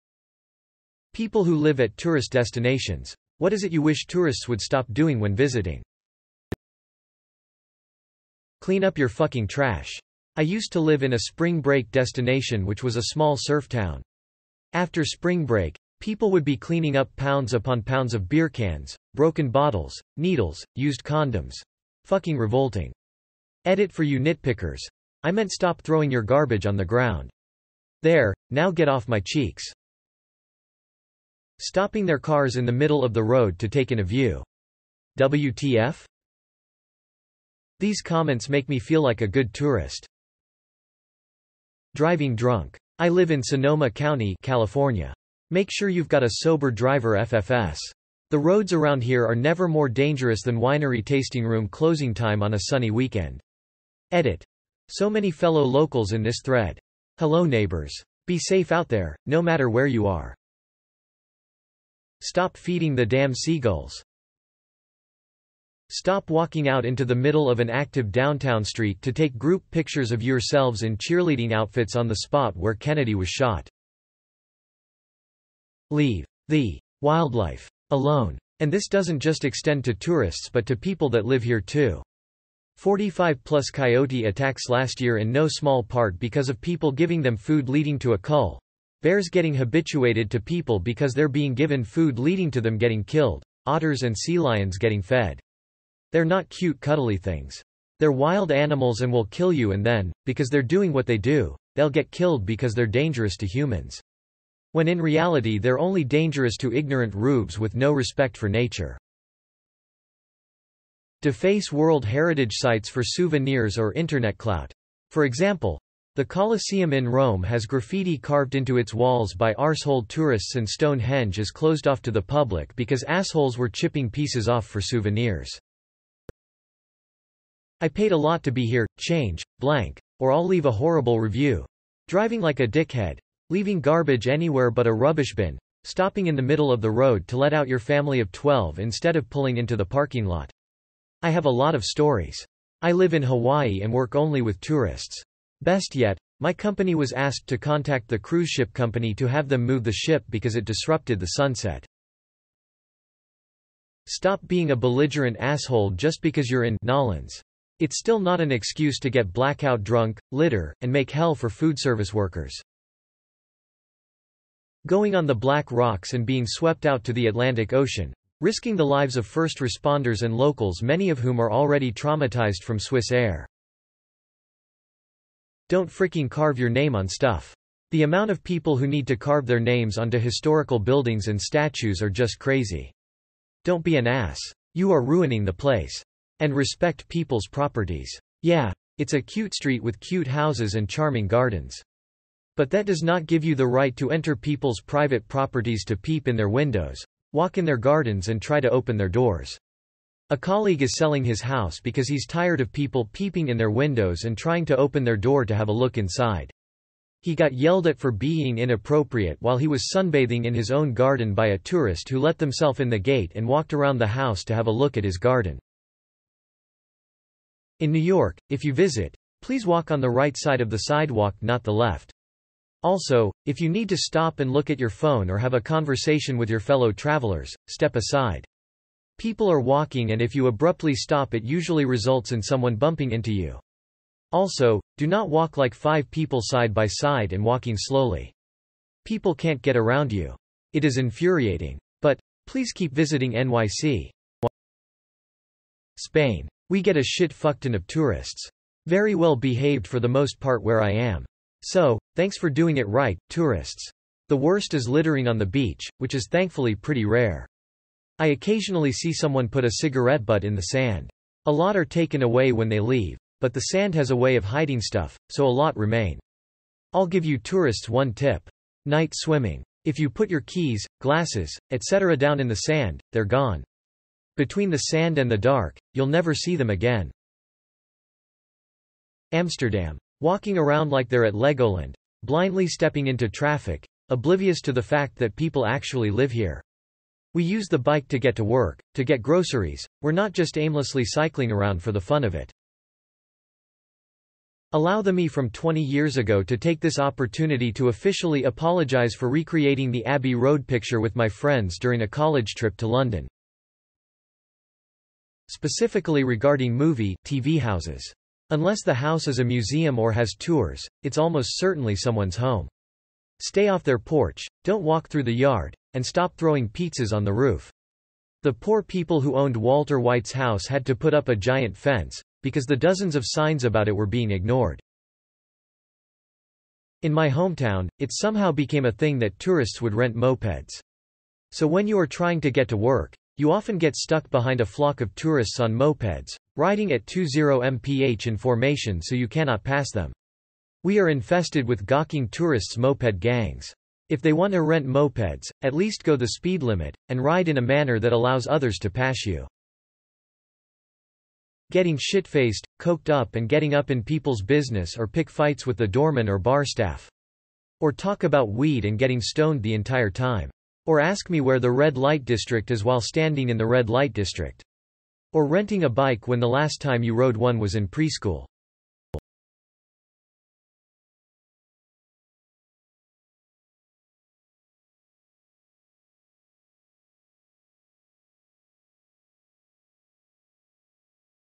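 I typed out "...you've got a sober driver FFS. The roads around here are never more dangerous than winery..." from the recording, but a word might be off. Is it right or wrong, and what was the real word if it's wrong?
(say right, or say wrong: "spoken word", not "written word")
right.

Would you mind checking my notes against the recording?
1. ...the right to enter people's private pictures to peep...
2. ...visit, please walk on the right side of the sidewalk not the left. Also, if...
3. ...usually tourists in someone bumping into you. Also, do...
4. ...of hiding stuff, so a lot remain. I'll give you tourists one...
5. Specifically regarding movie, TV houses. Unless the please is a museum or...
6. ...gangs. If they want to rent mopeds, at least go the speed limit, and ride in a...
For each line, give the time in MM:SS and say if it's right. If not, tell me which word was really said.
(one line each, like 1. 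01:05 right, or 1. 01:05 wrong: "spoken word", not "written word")
1. 03:13 wrong: "properties", not "pictures"
2. 03:38 right
3. 03:51 wrong: "results", not "tourists"
4. 04:24 right
5. 05:05 wrong: "house", not "please"
6. 05:43 right.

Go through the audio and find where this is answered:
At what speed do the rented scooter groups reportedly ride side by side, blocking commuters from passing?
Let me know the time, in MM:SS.
05:37.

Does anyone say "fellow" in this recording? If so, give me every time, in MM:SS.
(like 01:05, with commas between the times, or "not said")
00:55, 03:46.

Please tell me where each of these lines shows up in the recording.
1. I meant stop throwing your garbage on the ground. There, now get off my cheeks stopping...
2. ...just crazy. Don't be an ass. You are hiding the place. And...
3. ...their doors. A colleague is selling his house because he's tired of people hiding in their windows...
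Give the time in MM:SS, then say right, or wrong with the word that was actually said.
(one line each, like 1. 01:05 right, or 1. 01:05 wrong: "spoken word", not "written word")
1. 00:25 right
2. 03:02 wrong: "ruining", not "hiding"
3. 03:18 wrong: "peeping", not "hiding".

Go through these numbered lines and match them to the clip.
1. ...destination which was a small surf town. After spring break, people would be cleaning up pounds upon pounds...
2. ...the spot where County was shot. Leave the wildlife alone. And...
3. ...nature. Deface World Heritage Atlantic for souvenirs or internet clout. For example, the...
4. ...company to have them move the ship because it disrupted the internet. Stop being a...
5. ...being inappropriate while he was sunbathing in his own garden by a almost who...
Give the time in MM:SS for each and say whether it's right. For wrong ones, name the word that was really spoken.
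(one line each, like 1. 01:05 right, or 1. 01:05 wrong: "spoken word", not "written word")
1. 00:11 right
2. 01:12 wrong: "Kennedy", not "County"
3. 01:48 wrong: "Sites", not "Atlantic"
4. 02:28 wrong: "sunset", not "internet"
5. 03:28 wrong: "tourist", not "almost".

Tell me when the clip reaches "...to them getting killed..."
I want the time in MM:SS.
01:32.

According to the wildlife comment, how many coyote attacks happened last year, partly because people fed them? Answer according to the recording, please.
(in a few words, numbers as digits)
45.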